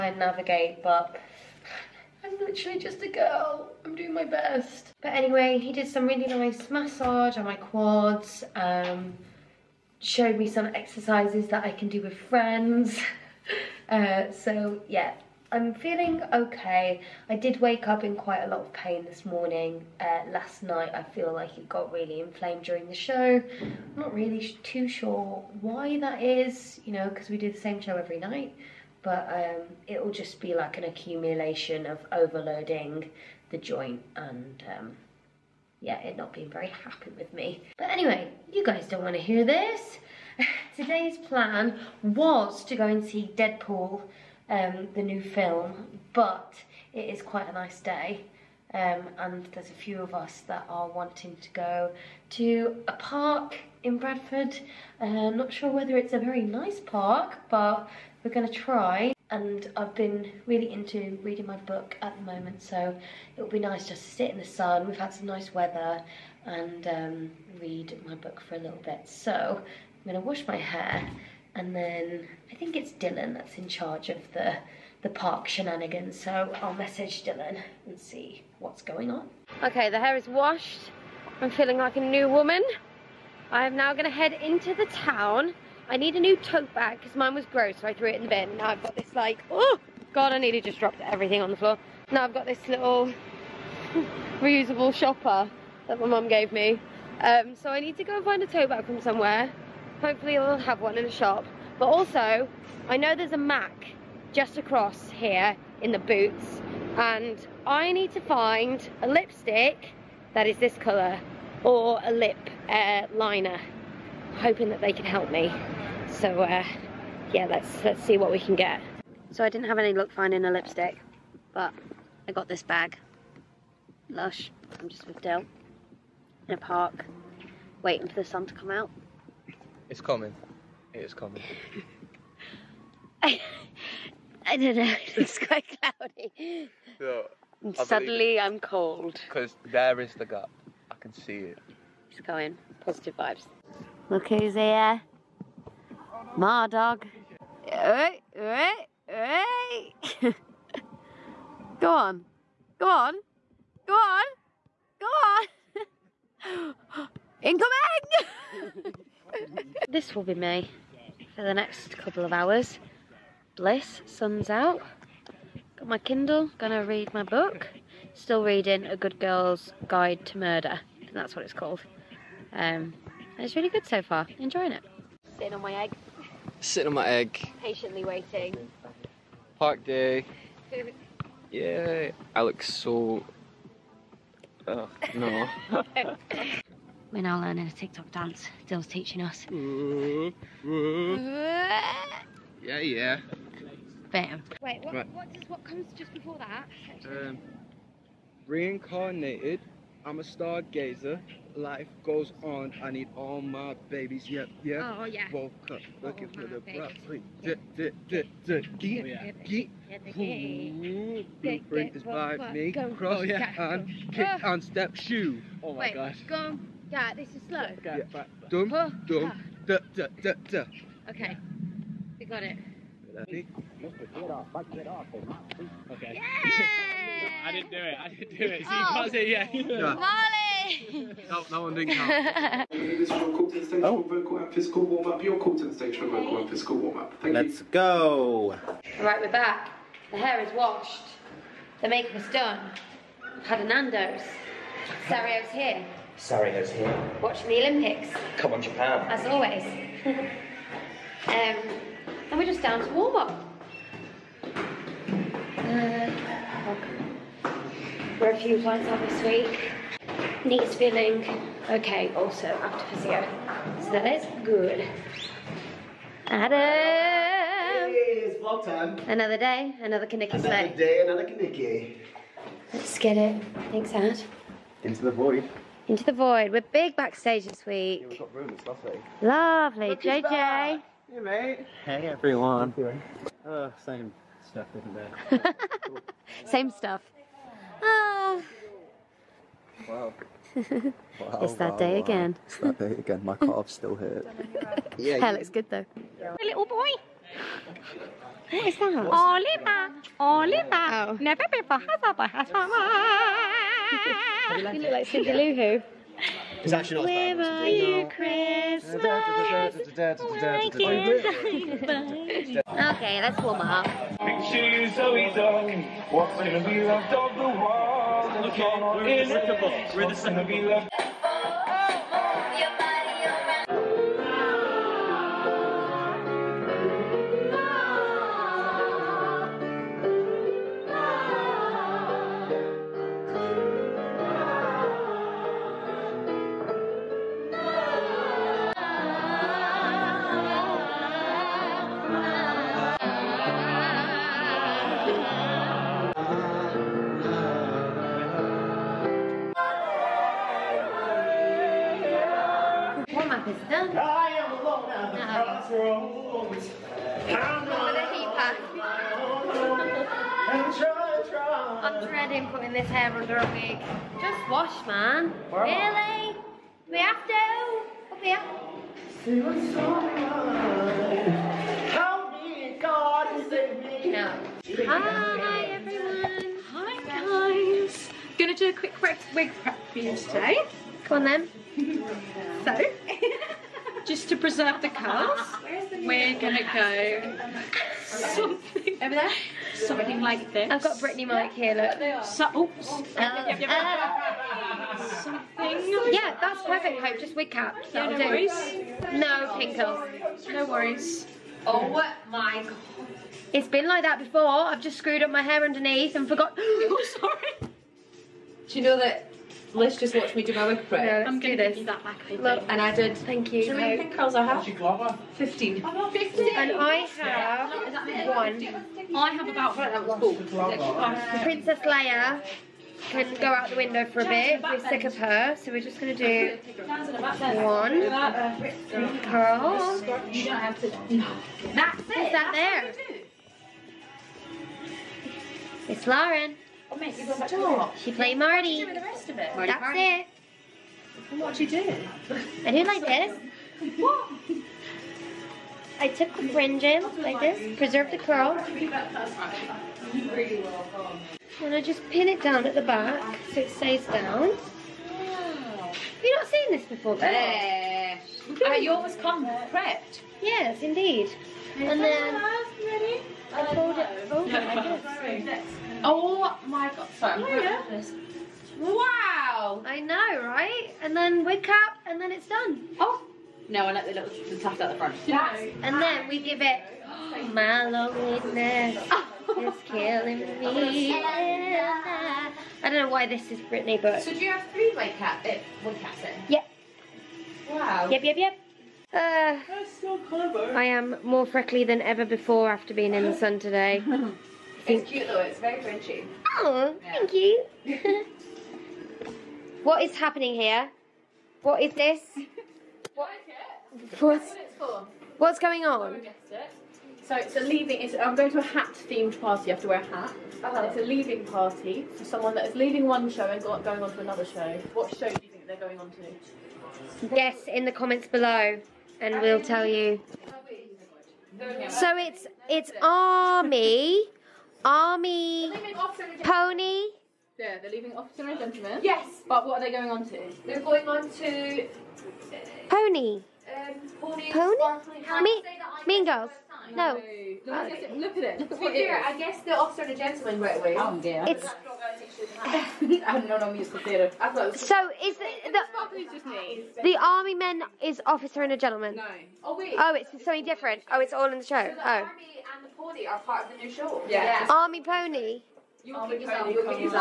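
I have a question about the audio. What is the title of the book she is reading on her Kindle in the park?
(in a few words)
A Good Girl's Guide to Murder.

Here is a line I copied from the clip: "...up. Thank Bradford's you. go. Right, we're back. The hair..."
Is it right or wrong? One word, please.
wrong.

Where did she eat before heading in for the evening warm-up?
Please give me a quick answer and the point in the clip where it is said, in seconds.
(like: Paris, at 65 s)
Nando's, at 243 s.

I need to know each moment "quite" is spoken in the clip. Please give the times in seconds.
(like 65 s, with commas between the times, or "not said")
18 s, 47 s, 135 s.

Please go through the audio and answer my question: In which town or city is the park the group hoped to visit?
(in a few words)
Bradford.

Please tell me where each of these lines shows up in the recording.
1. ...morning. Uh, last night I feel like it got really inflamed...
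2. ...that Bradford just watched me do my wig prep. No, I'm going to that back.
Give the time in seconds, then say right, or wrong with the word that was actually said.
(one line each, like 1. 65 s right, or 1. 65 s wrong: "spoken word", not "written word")
1. 19 s right
2. 408 s wrong: "Liz", not "Bradford".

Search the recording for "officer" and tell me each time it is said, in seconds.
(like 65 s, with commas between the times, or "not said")
528 s, 539 s, 548 s.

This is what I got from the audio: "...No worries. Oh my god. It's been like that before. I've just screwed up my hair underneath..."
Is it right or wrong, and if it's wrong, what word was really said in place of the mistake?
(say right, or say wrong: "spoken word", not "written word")
right.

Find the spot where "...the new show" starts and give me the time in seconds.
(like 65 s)
553 s.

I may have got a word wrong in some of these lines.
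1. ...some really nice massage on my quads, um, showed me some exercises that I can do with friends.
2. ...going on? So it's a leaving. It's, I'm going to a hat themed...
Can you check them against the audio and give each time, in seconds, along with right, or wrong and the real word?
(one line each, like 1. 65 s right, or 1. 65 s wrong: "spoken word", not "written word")
1. 5 s right
2. 505 s right.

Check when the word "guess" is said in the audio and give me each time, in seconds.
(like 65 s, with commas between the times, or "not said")
517 s, 539 s.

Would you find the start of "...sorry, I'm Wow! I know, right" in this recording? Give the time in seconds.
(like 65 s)
467 s.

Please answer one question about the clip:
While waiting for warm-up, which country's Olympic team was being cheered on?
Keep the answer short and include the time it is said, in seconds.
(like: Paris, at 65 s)
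Japan, at 248 s.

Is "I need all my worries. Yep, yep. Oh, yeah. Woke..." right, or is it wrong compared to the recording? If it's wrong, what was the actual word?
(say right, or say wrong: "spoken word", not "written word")
wrong: "babies", not "worries".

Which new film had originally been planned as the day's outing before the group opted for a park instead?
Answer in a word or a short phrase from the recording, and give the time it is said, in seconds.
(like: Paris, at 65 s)
Deadpool, at 43 s.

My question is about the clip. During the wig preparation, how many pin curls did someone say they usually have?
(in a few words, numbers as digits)
15.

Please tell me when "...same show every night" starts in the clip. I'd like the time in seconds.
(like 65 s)
27 s.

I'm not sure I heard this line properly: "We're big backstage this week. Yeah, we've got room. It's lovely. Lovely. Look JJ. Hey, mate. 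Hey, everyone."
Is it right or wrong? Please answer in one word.
right.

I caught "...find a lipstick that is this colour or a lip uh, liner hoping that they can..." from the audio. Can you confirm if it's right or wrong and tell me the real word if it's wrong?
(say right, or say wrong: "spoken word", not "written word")
right.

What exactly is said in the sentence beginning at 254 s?
Uh, we're a few points up this week.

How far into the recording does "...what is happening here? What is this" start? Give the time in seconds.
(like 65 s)
499 s.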